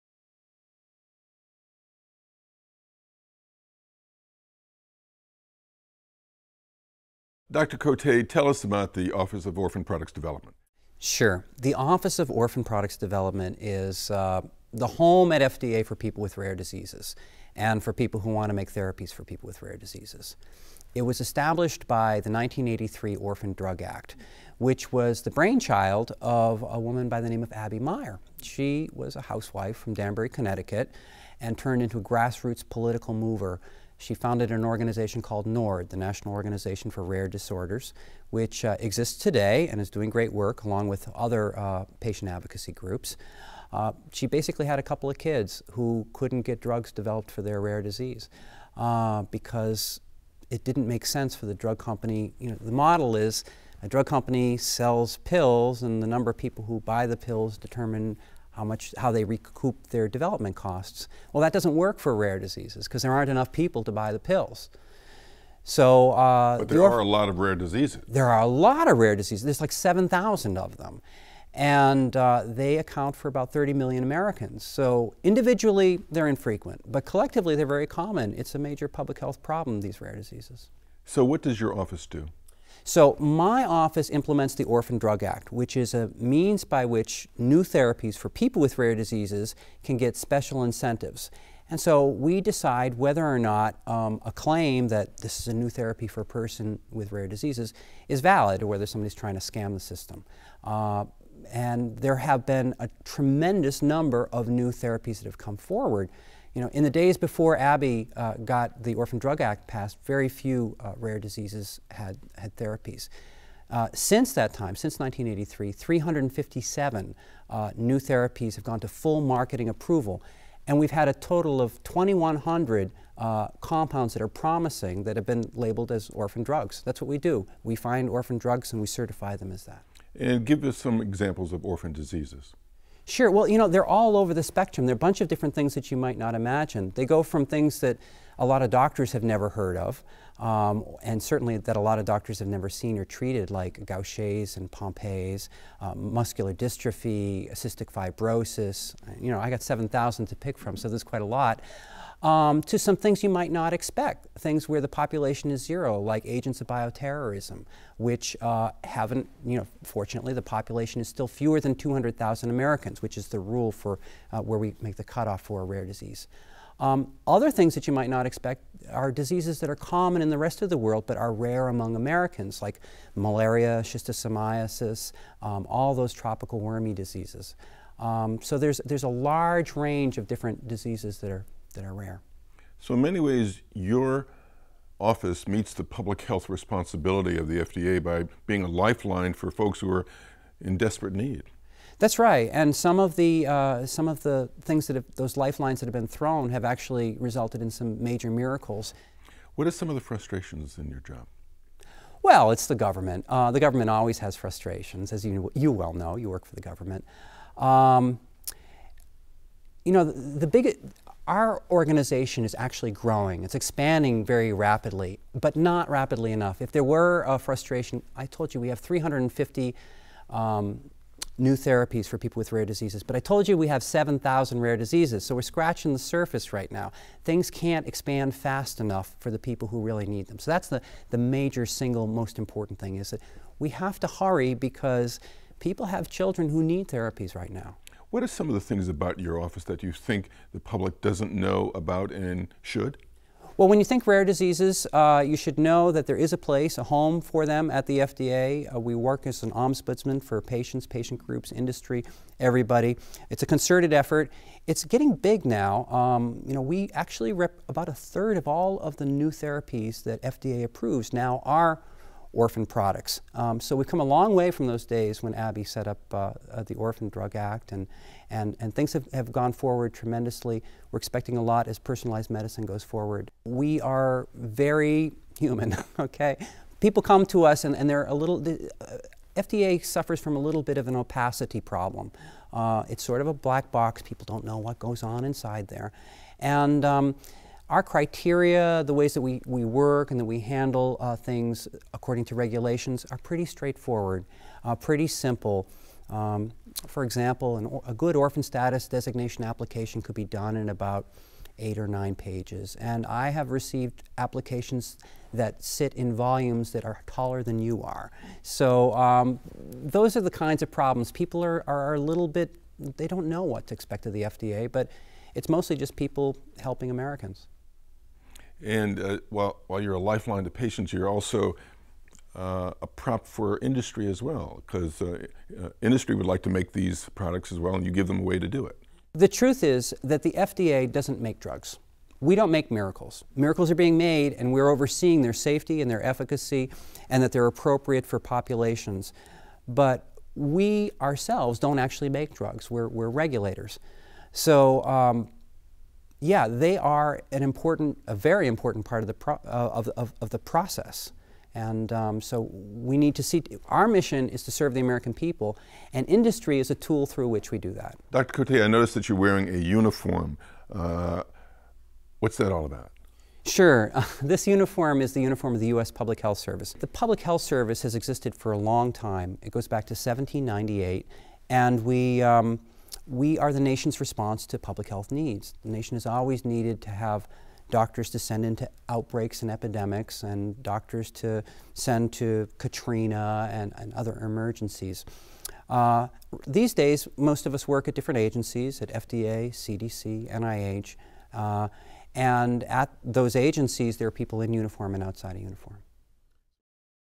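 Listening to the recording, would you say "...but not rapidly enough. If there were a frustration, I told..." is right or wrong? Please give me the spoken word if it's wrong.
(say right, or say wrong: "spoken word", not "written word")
right.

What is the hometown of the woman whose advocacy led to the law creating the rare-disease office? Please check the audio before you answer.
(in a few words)
Danbury, Connecticut.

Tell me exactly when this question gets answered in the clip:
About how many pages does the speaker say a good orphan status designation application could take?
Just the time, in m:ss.
5:01.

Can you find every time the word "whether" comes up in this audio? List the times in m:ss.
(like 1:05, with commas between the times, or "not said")
1:32, 1:38.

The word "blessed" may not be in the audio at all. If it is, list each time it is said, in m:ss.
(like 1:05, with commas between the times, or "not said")
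not said.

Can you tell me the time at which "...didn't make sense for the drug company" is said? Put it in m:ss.
0:50.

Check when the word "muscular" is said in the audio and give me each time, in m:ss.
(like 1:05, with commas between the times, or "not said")
2:26.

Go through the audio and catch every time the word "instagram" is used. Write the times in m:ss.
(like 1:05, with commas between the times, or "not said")
not said.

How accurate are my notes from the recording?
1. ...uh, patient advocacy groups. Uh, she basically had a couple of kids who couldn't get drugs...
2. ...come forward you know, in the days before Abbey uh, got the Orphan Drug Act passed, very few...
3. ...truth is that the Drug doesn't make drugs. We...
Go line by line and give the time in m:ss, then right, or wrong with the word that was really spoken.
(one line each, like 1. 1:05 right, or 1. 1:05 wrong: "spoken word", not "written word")
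1. 0:41 right
2. 1:45 right
3. 5:29 wrong: "FDA", not "Drug".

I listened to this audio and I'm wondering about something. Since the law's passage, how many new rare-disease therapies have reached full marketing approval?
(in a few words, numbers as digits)
357.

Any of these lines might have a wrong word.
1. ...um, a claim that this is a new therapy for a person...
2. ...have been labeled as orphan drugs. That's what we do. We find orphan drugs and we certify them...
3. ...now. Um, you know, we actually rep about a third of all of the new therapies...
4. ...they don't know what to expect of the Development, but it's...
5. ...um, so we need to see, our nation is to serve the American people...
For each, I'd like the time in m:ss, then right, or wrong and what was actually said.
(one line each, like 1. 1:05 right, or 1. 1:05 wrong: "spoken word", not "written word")
1. 1:33 right
2. 2:05 right
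3. 4:15 right
4. 5:12 wrong: "FDA", not "Development"
5. 5:51 wrong: "mission", not "nation".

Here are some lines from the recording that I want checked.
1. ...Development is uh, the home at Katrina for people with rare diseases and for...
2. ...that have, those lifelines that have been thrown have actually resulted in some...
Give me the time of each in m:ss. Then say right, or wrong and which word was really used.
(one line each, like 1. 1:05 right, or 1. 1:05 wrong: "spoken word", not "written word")
1. 0:12 wrong: "FDA", not "Katrina"
2. 3:14 right.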